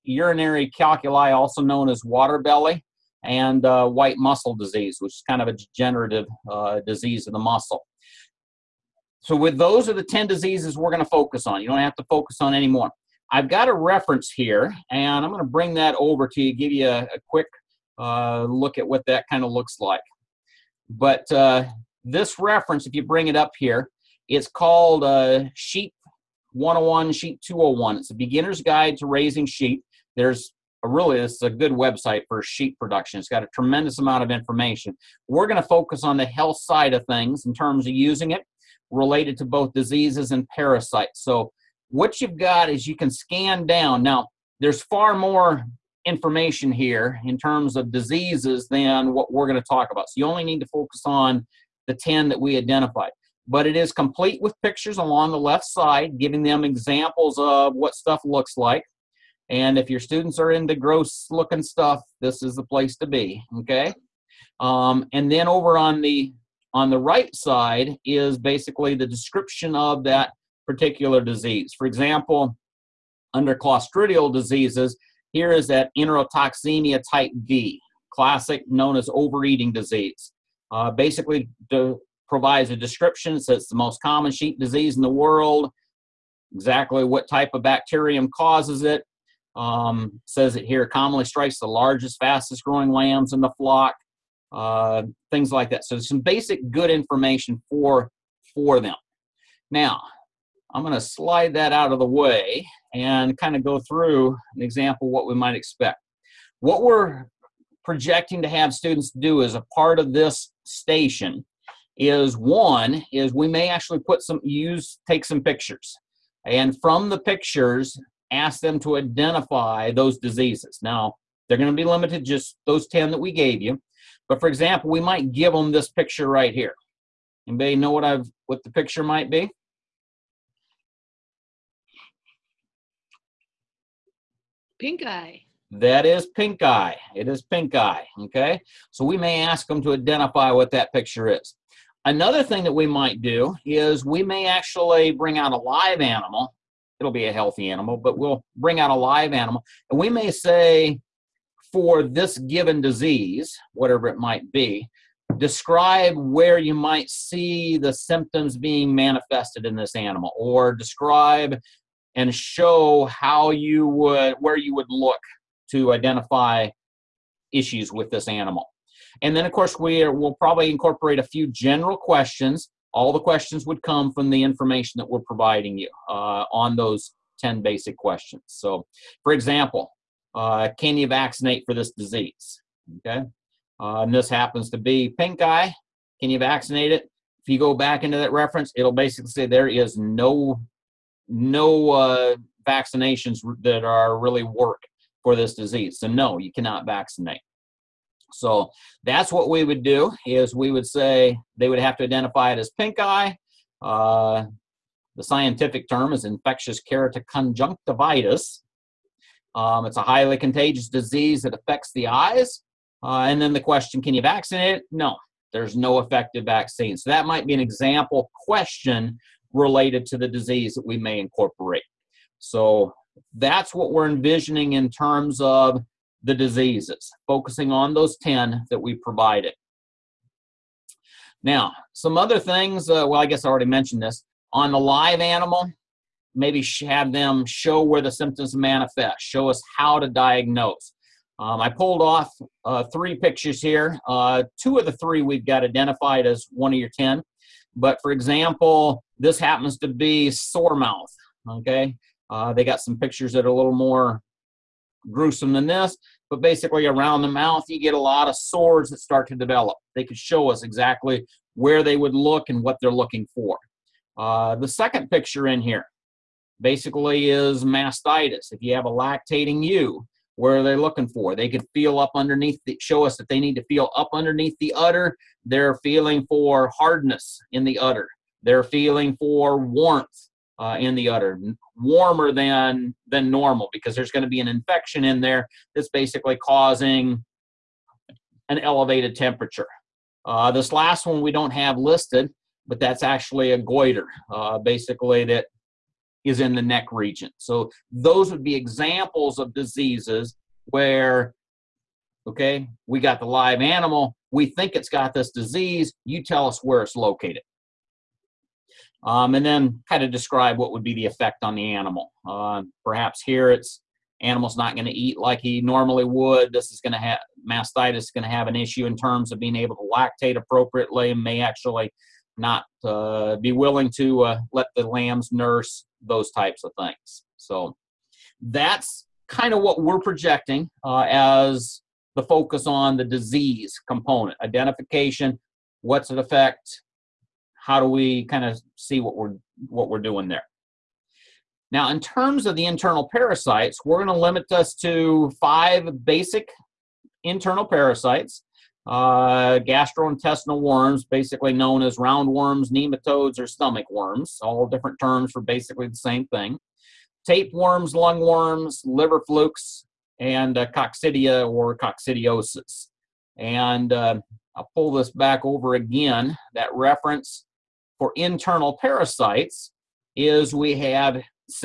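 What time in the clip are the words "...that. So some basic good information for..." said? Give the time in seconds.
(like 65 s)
95 s.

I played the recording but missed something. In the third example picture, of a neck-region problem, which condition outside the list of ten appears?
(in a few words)
Goiter.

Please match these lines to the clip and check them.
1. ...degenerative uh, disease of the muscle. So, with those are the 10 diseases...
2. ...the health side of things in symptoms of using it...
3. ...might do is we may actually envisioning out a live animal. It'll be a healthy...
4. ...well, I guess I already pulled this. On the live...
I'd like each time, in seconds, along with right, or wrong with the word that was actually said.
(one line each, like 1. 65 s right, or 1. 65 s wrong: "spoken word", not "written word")
1. 5 s right
2. 36 s wrong: "terms", not "symptoms"
3. 142 s wrong: "bring", not "envisioning"
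4. 233 s wrong: "mentioned", not "pulled".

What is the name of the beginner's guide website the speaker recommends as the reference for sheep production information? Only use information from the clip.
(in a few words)
Sheep 101, Sheep 201.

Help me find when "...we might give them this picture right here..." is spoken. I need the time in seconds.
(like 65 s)
124 s.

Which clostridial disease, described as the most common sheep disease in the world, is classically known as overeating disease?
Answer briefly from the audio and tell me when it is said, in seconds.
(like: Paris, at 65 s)
Enterotoxemia type D, at 75 s.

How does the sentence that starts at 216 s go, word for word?
So that might be an example question related to the disease that we may incorporate.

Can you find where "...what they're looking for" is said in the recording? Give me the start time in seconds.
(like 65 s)
262 s.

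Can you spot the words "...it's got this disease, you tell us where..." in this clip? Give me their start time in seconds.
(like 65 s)
304 s.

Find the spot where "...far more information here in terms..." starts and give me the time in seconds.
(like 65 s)
44 s.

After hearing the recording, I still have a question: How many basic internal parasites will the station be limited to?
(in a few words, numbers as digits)
5.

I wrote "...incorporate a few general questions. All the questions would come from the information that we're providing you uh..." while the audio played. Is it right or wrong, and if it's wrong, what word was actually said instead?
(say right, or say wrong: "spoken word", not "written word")
right.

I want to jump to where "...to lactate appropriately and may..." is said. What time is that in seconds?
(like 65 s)
319 s.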